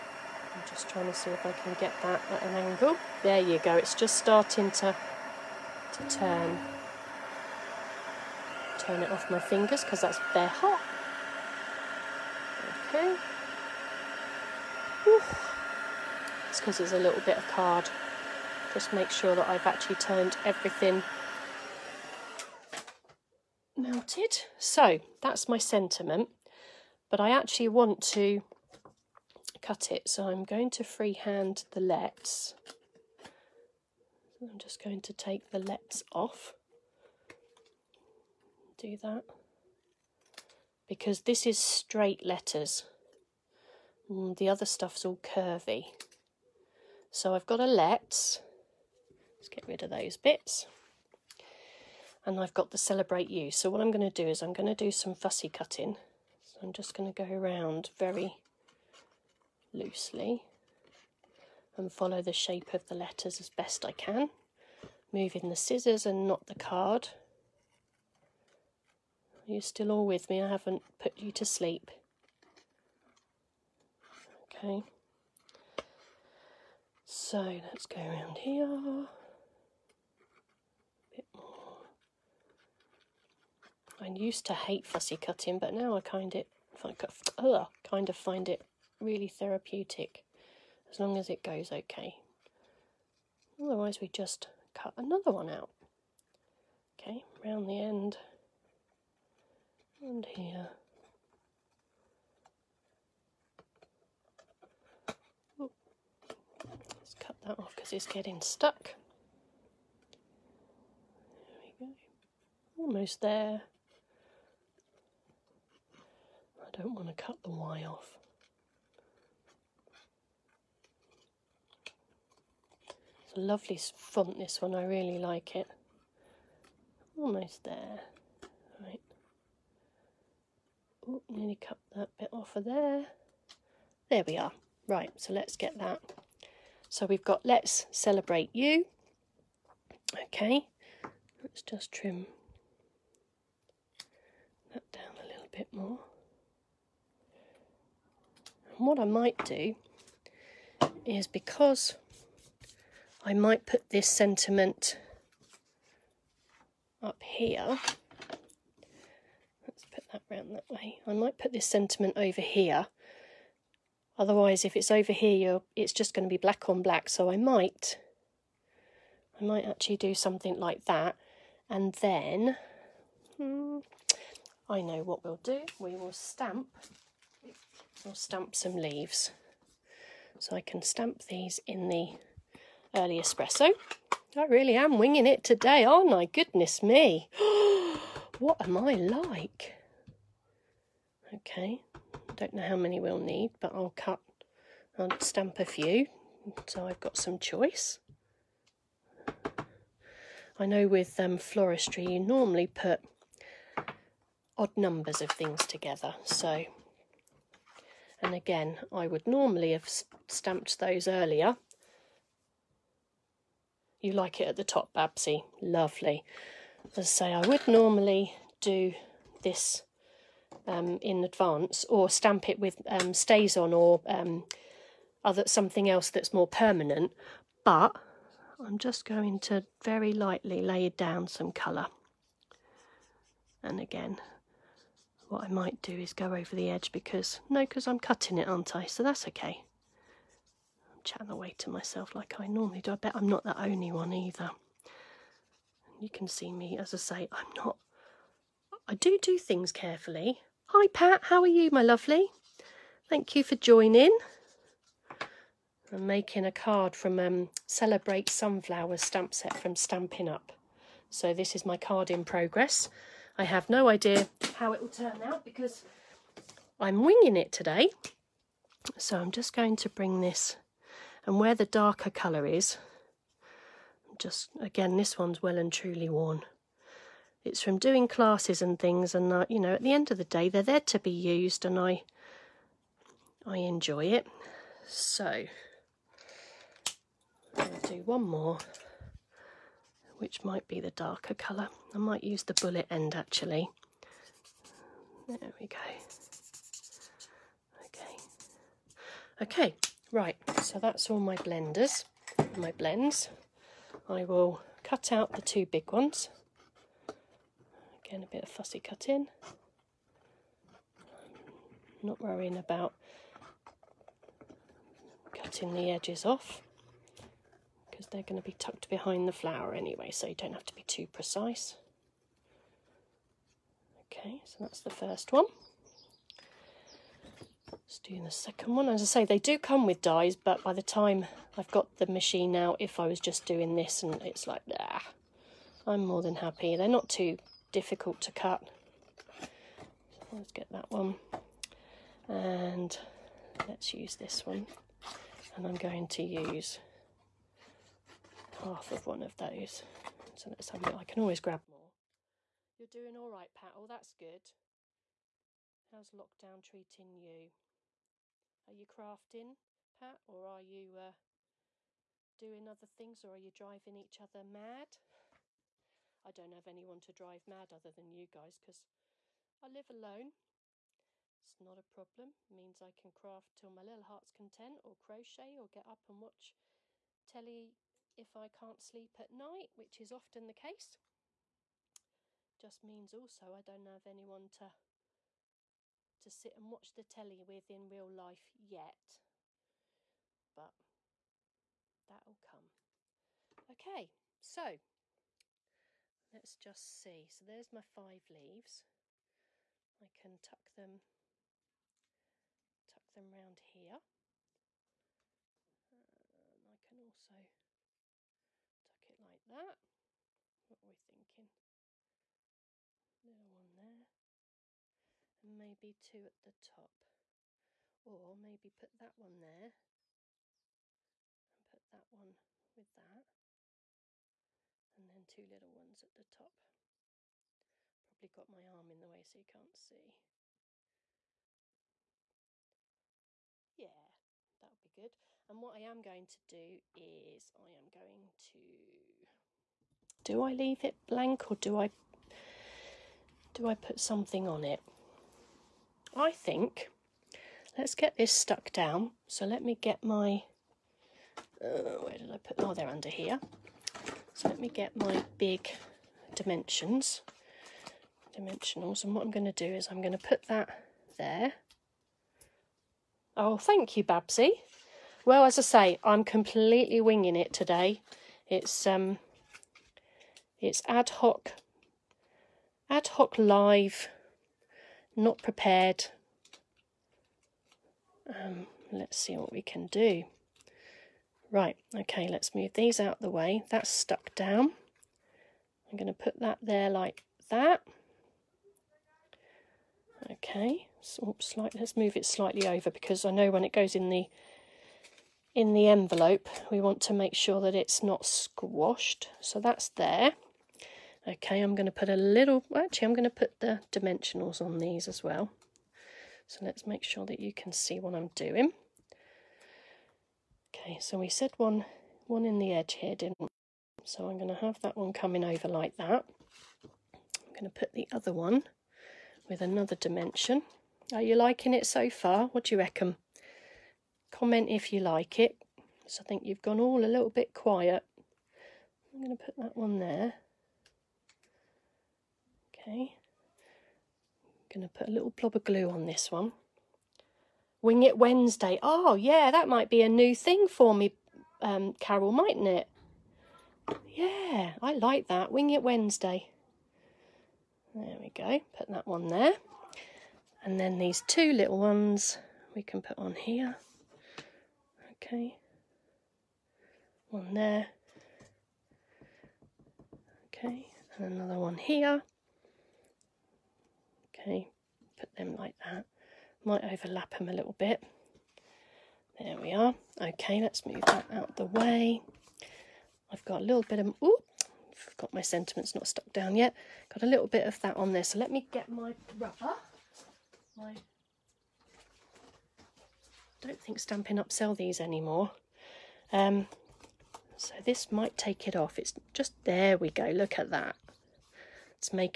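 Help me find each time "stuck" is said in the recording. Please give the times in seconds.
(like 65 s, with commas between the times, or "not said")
108 s, 448 s, 483 s, 576 s.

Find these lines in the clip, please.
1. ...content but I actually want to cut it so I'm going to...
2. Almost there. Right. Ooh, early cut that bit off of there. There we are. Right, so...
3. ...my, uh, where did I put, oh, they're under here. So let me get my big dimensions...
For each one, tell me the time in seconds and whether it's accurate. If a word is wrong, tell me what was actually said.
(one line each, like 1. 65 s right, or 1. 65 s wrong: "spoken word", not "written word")
1. 25 s wrong: "sentiment", not "content"
2. 127 s wrong: "nearly", not "early"
3. 450 s right.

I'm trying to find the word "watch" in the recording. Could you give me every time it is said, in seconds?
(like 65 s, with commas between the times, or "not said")
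376 s, 386 s.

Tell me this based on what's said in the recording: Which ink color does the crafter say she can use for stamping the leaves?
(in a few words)
Early Espresso.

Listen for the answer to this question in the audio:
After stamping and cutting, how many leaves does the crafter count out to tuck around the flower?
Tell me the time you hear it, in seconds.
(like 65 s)
397 s.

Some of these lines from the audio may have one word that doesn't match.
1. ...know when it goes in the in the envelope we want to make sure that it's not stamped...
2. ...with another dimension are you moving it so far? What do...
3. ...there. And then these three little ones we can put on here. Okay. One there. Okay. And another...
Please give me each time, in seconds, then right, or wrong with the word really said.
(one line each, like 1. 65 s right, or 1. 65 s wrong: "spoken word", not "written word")
1. 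493 s wrong: "squashed", not "stamped"
2. 519 s wrong: "liking", not "moving"
3. 549 s wrong: "two", not "three".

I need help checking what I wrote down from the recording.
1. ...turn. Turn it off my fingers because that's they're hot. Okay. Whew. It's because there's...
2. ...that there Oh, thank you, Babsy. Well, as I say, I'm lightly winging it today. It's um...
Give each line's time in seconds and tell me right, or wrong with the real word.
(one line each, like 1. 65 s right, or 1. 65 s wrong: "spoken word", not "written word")
1. 6 s right
2. 460 s wrong: "completely", not "lightly".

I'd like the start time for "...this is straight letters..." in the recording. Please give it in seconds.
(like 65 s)
41 s.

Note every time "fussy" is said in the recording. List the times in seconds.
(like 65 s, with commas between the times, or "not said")
55 s, 84 s, 308 s.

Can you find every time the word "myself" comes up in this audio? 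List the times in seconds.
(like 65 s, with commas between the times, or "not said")
241 s.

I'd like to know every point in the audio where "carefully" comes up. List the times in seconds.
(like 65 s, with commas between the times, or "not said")
249 s.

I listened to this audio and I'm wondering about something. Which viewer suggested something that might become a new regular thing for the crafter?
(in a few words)
Carol.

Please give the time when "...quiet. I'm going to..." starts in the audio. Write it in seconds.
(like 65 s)
527 s.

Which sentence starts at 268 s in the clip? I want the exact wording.
So I'm just going to bring this and where the darker colour is, just again, this one's well and truly worn.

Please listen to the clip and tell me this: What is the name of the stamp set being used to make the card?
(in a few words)
Celebrate Sunflower.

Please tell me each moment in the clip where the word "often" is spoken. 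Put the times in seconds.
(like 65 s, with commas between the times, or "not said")
380 s.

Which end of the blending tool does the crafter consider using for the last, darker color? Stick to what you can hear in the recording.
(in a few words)
The bullet end.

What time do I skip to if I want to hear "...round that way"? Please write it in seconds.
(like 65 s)
160 s.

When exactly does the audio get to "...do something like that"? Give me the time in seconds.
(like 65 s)
169 s.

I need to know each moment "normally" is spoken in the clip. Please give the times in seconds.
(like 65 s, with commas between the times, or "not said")
202 s, 209 s, 217 s, 242 s.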